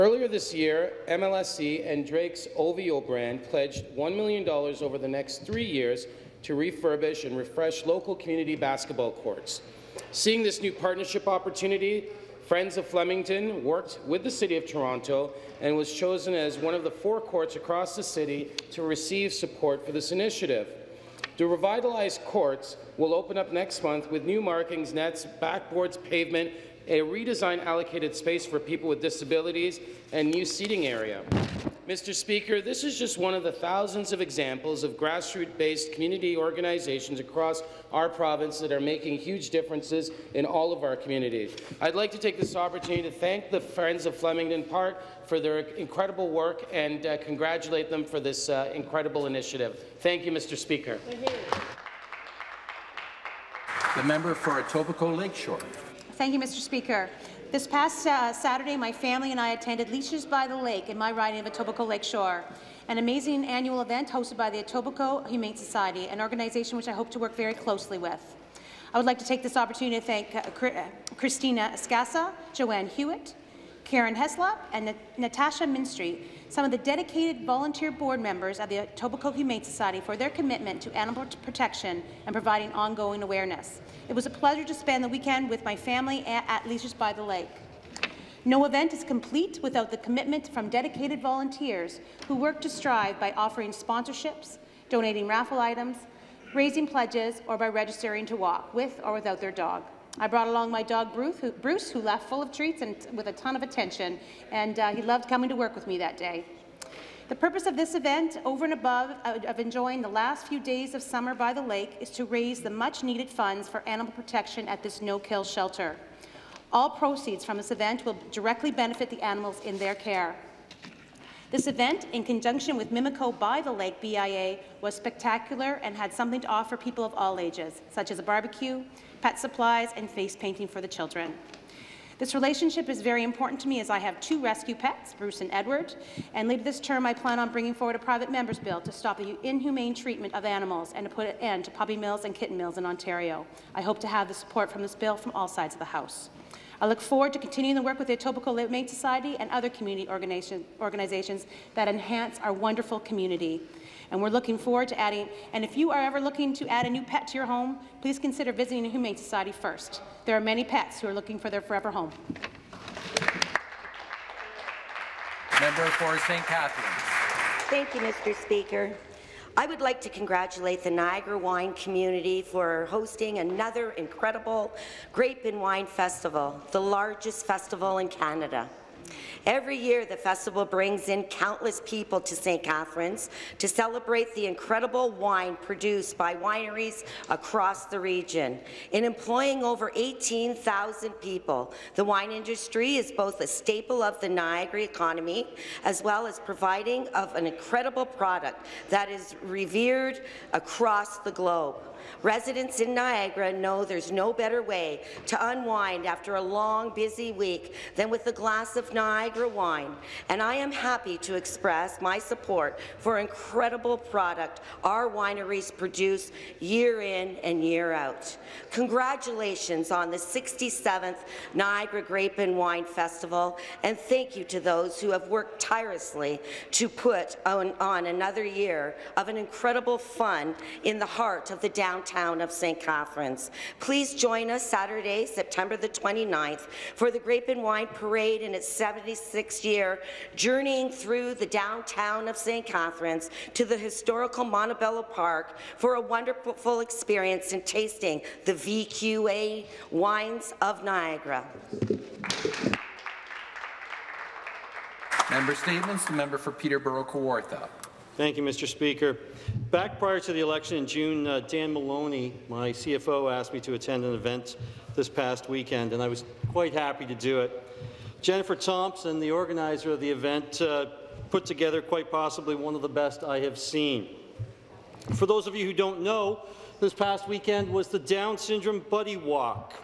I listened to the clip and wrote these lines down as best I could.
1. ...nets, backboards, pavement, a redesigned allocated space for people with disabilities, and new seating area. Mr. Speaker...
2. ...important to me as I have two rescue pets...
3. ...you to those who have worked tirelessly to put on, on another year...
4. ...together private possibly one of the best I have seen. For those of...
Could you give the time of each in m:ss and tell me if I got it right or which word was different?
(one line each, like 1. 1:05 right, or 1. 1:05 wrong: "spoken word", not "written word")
1. 0:24 right
2. 2:13 right
3. 3:44 right
4. 4:31 wrong: "quite", not "private".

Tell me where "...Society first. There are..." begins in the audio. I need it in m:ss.
2:39.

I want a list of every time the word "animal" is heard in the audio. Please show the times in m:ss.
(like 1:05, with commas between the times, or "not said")
1:20, 1:53, 1:59, 2:20.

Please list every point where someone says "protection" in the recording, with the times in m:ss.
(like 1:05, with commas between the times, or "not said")
1:21, 1:54.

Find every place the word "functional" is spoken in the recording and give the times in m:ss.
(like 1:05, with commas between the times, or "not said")
not said.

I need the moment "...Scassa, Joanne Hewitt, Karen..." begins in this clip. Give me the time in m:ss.
1:11.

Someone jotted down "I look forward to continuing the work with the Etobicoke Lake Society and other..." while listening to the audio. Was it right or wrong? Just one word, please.
wrong.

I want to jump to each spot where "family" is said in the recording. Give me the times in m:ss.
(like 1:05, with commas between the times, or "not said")
0:58, 1:25.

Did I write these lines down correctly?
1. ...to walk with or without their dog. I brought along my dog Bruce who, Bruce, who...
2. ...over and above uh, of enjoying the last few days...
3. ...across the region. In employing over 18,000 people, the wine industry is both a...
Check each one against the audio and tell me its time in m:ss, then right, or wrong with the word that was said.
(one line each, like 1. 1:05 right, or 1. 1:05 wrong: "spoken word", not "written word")
1. 1:38 right
2. 1:48 right
3. 3:07 right.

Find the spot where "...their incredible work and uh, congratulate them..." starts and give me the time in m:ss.
0:45.